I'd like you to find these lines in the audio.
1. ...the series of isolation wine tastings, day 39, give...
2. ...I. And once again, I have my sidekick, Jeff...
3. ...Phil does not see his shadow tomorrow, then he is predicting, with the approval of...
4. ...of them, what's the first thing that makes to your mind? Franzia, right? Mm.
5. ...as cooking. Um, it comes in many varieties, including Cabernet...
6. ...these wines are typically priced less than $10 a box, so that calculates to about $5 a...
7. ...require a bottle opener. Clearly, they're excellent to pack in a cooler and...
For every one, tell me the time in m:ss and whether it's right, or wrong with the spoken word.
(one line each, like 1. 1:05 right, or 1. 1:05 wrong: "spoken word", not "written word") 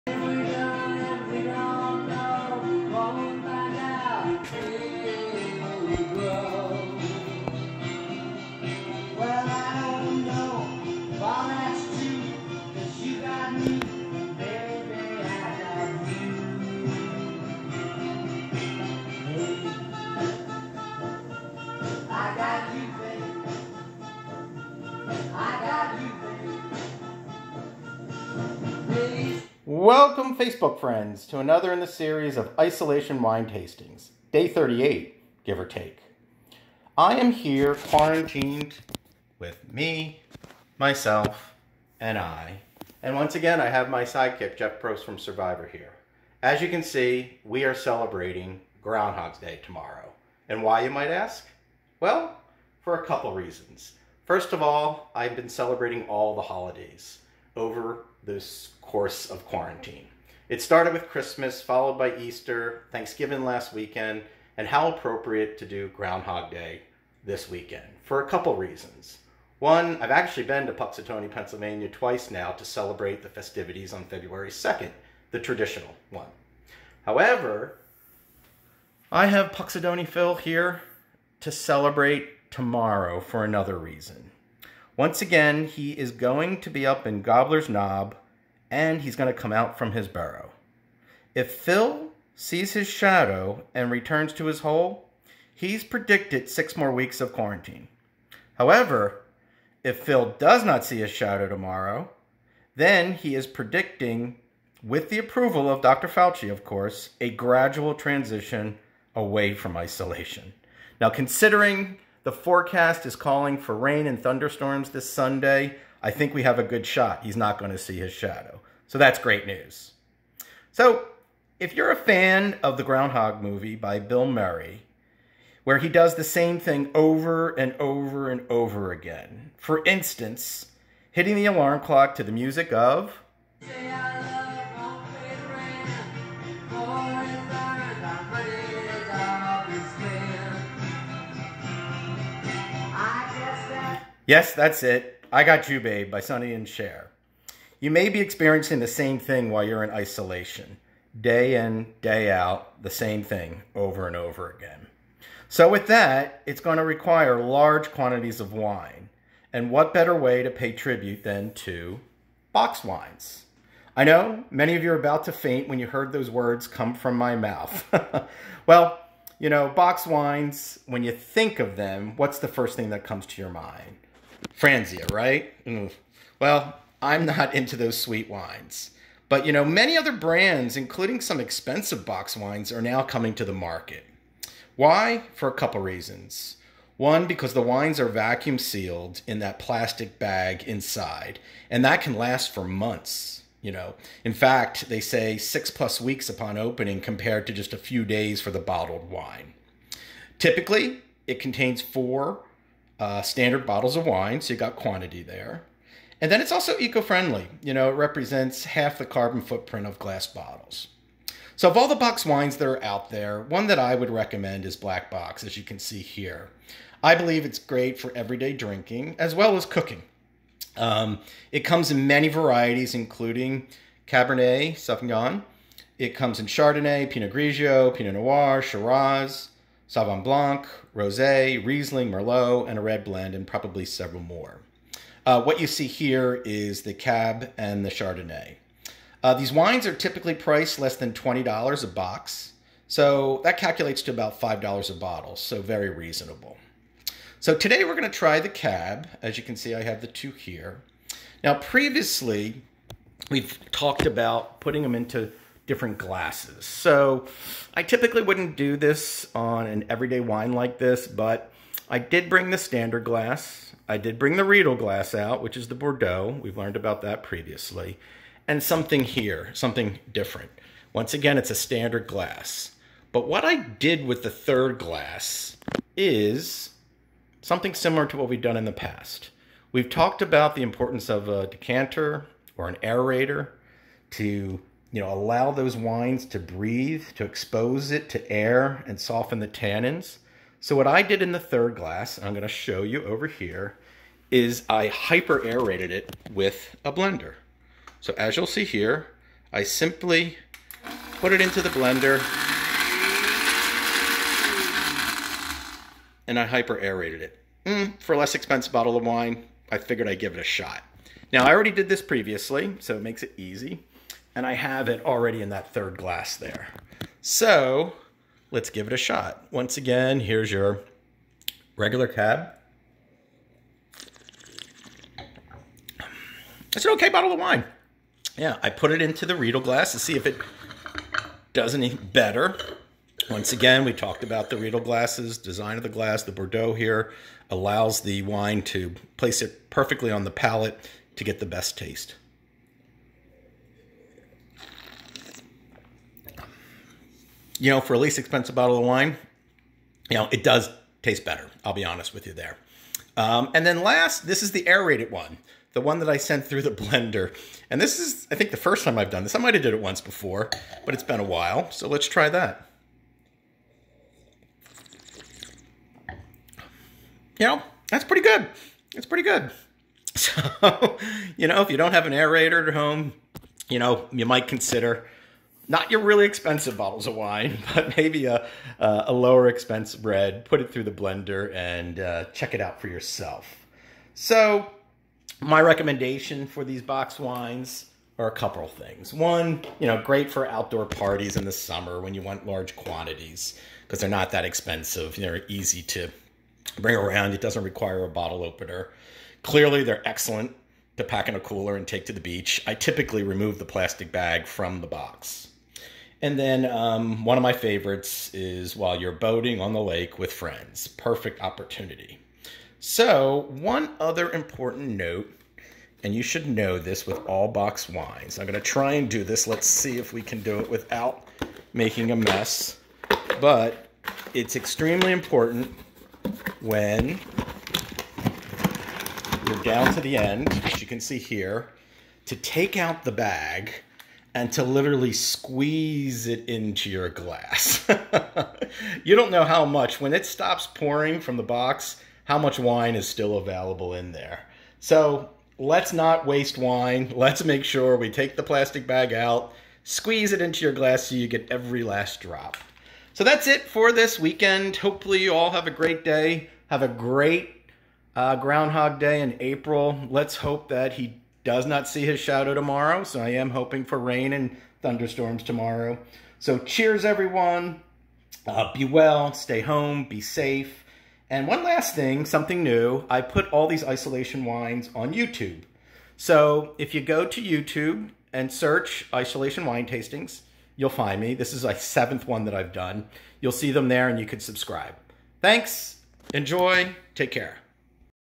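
1. 0:31 wrong: "38", not "39"
2. 0:42 right
3. 1:39 right
4. 2:51 wrong: "comes", not "makes"
5. 3:39 right
6. 3:59 wrong: "20", not "10"
7. 6:37 right.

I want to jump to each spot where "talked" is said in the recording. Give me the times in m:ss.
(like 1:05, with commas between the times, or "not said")
4:13, 4:39, 5:33.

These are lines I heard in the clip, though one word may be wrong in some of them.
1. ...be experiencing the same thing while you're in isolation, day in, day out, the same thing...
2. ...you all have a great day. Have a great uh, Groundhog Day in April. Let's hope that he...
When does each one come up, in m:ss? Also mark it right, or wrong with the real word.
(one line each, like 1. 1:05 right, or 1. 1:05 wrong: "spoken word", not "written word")
1. 2:28 right
2. 7:35 right.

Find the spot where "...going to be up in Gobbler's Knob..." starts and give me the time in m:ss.
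1:26.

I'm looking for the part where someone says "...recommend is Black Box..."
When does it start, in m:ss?
3:34.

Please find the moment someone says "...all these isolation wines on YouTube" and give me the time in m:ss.
7:53.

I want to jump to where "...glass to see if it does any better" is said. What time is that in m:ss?
5:29.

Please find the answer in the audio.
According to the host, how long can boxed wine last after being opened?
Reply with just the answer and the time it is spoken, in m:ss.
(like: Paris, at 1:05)
6+ weeks, at 3:15.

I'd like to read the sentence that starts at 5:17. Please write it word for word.
So let's give it a shot.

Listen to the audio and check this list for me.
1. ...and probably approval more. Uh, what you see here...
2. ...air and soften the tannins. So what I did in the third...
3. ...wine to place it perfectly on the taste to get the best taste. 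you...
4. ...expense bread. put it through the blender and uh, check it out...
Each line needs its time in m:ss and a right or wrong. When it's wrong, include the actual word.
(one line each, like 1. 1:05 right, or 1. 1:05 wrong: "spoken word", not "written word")
1. 3:53 wrong: "several", not "approval"
2. 4:48 right
3. 5:38 wrong: "palate", not "taste"
4. 6:19 right.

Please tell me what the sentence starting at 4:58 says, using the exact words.
So as you'll see here, I simply put it into the blender and I hyper aerated it.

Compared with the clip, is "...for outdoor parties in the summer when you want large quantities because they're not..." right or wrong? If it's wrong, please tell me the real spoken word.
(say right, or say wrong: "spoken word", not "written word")
right.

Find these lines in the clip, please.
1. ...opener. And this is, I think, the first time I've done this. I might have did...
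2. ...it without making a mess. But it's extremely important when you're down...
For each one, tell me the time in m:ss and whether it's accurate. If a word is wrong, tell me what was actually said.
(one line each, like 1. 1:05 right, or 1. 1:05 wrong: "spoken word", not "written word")
1. 5:56 wrong: "blender", not "opener"
2. 7:00 right.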